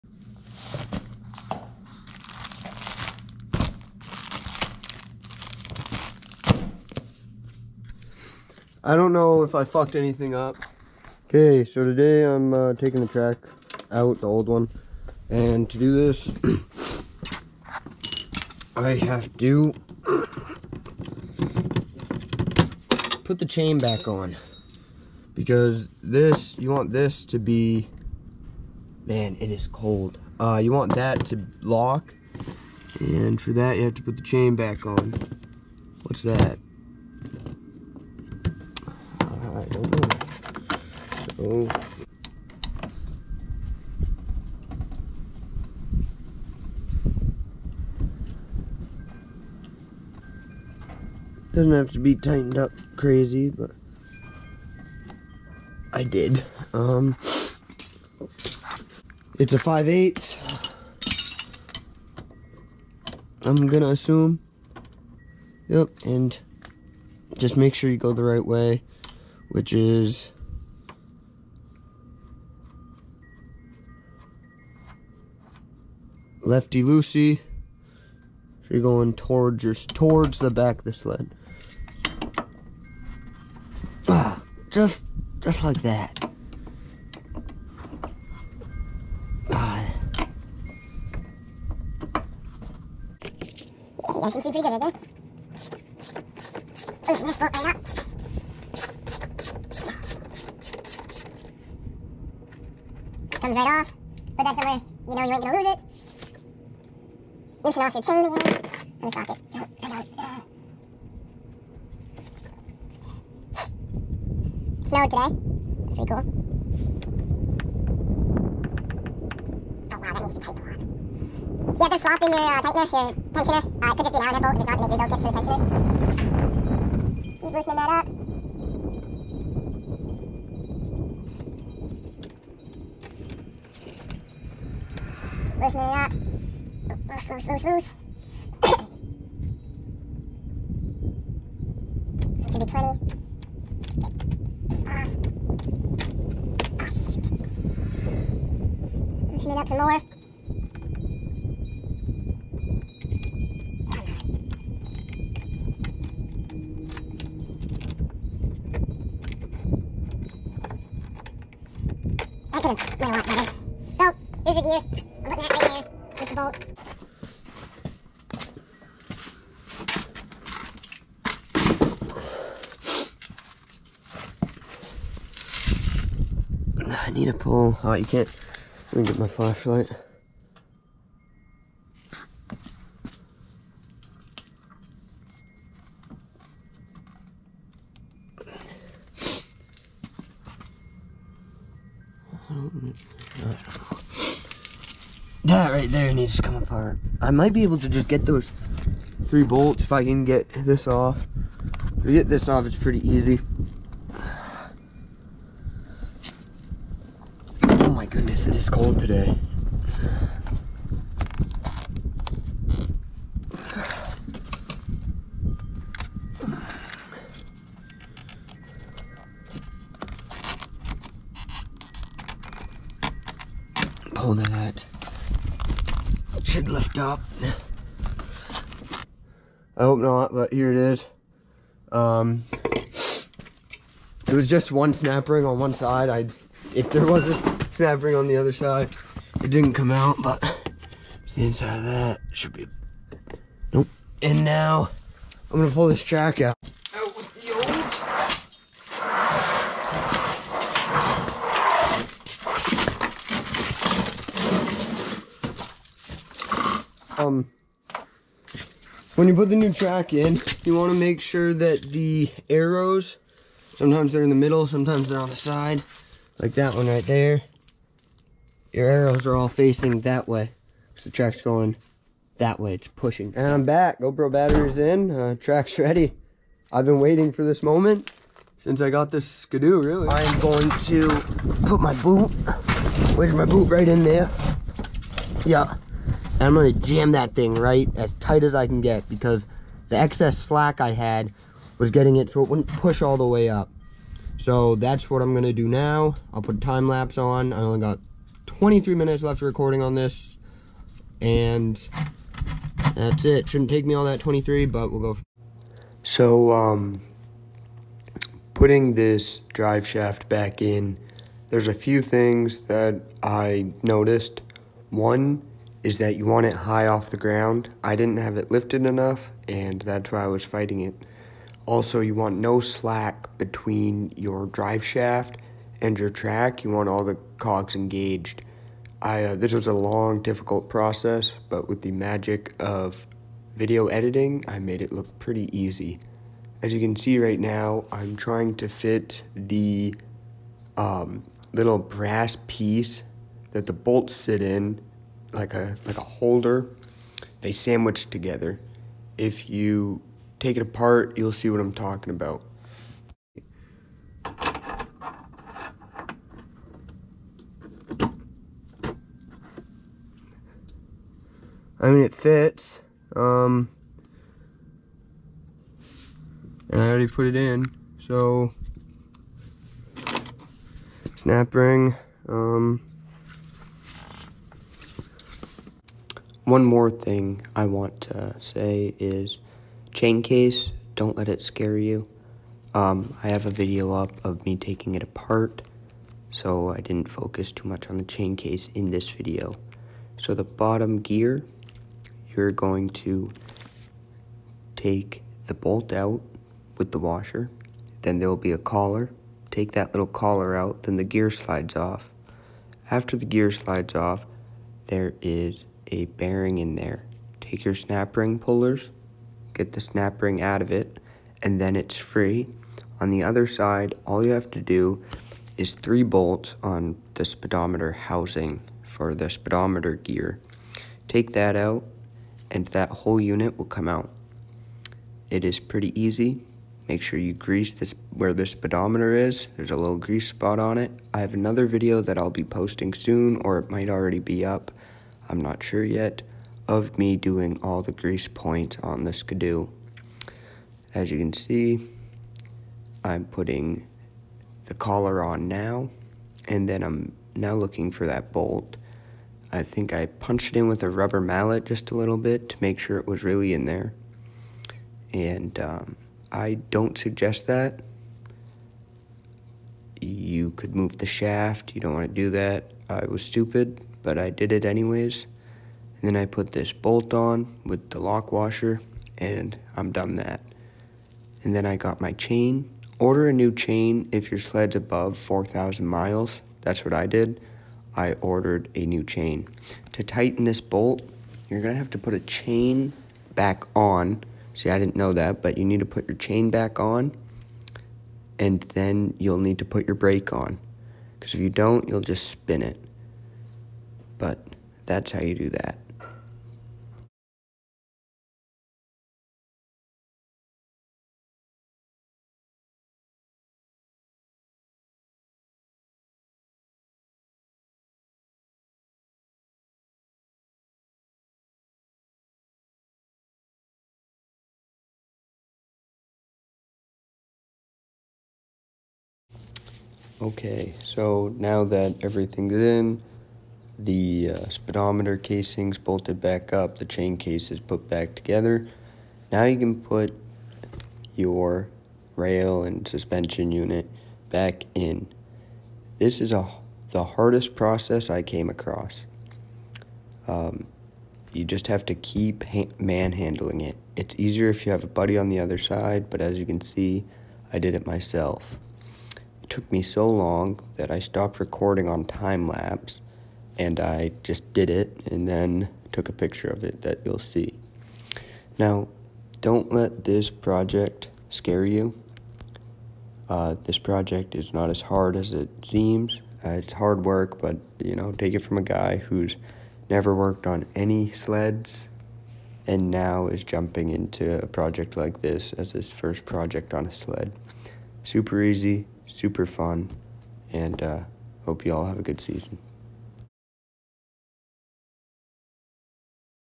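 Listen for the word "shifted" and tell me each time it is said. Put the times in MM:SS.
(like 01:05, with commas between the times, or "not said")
not said.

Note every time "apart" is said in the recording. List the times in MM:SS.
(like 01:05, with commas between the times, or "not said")
03:16, 05:50, 06:25.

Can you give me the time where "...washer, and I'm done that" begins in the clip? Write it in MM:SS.
07:48.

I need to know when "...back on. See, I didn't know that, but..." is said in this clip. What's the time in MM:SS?
08:03.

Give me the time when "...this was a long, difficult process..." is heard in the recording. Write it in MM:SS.
05:29.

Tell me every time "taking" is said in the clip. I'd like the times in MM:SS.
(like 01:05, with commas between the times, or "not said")
00:12, 06:24.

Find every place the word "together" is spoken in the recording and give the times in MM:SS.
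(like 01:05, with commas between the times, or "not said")
05:48, 08:48.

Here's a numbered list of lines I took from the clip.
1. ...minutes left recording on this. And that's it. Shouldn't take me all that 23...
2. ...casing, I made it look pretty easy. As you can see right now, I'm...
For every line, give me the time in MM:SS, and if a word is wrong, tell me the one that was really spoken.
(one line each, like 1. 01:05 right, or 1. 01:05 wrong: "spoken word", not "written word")
1. 04:58 right
2. 05:33 wrong: "editing", not "casing".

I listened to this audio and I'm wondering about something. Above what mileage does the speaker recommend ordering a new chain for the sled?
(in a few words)
4,000 miles.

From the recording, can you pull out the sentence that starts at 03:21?
If you get this off, it's pretty easy.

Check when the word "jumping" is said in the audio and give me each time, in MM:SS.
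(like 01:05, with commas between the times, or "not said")
09:33.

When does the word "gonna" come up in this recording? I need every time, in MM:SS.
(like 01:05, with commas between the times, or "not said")
01:03, 01:45, 04:05.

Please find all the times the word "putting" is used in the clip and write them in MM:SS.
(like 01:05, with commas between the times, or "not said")
02:45, 05:08, 07:23.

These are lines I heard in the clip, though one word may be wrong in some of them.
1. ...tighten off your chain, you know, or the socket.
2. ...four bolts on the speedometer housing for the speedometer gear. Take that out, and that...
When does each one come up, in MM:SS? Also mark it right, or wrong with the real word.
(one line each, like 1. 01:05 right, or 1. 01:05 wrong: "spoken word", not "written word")
1. 01:47 wrong: "loosen", not "tighten"
2. 06:55 wrong: "three", not "four".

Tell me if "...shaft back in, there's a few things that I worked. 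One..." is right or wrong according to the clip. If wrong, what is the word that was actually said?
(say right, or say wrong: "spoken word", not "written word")
wrong: "noticed", not "worked".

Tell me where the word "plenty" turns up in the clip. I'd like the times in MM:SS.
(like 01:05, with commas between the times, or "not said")
02:22.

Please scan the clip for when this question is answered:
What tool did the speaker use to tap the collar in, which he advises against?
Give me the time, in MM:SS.
07:30.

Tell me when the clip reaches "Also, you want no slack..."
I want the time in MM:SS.
05:21.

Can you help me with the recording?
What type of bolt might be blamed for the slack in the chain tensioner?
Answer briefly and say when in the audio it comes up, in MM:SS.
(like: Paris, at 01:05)
Allen bolt, at 02:04.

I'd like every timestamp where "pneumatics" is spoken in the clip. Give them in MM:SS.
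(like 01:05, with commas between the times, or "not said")
not said.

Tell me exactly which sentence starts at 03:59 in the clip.
It didn't come out, but the inside of that should be, nope.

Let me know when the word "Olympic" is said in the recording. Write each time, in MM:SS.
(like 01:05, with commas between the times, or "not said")
not said.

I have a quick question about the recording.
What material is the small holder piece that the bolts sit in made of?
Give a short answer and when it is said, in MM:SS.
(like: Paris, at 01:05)
brass, at 05:41.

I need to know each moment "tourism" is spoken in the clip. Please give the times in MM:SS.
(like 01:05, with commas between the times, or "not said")
not said.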